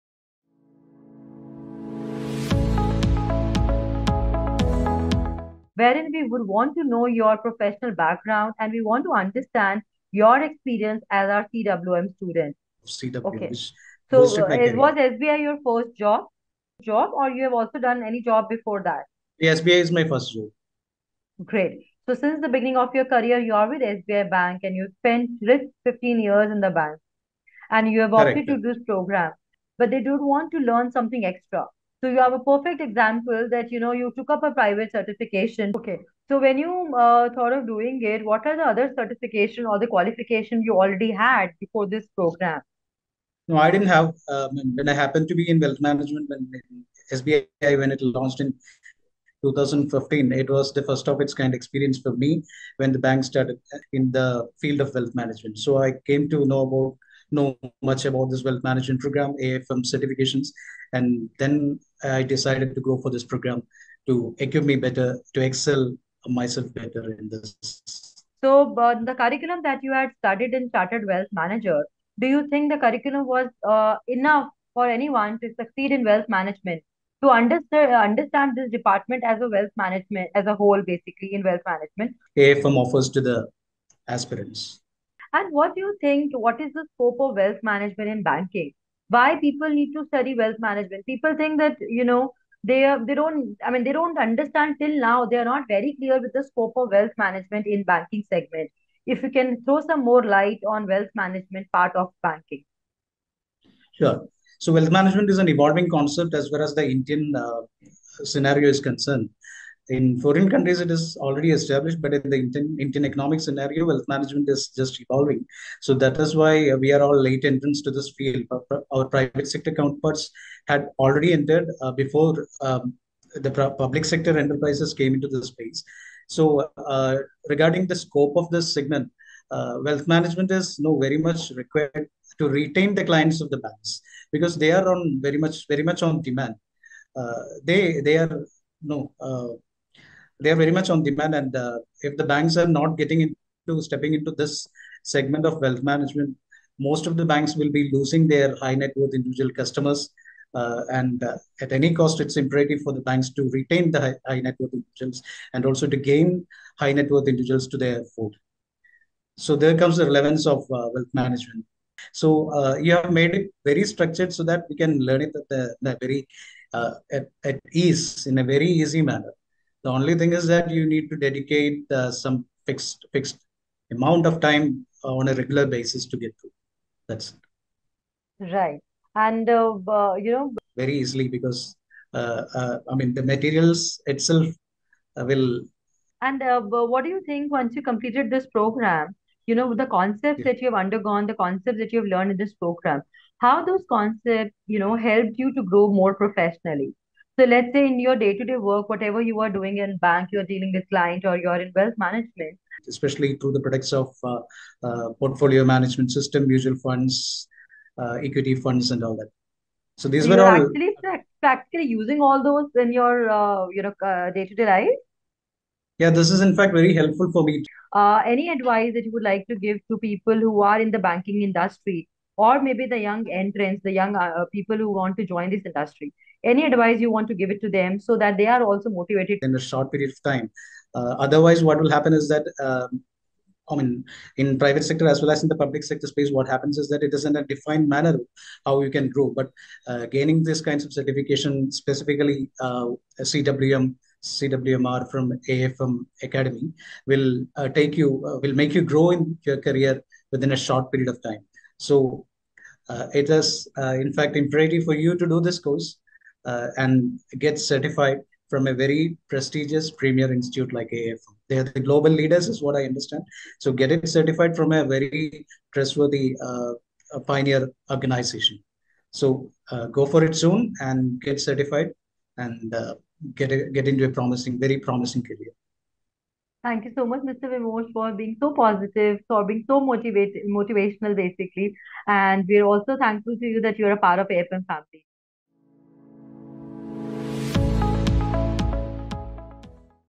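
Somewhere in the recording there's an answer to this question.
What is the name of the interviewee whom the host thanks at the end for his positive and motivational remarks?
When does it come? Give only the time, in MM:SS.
04:37.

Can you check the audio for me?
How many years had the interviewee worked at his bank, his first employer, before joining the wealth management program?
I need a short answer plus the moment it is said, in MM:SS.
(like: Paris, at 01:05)
15, at 00:25.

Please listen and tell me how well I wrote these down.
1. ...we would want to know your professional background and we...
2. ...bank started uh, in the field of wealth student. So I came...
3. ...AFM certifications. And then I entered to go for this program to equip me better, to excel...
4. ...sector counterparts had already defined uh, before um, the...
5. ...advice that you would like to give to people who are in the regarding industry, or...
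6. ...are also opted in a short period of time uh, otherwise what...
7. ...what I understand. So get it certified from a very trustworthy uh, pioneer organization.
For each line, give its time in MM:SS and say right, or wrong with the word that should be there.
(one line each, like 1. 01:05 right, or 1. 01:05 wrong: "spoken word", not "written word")
1. 00:06 right
2. 00:52 wrong: "management", not "student"
3. 00:59 wrong: "decided", not "entered"
4. 01:59 wrong: "entered", not "defined"
5. 03:38 wrong: "banking", not "regarding"
6. 03:48 wrong: "motivated", not "opted"
7. 04:22 right.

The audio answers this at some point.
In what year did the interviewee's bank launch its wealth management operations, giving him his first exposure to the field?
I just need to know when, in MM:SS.
00:49.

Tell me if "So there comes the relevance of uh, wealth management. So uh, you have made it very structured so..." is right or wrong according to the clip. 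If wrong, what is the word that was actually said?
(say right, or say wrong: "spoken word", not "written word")
right.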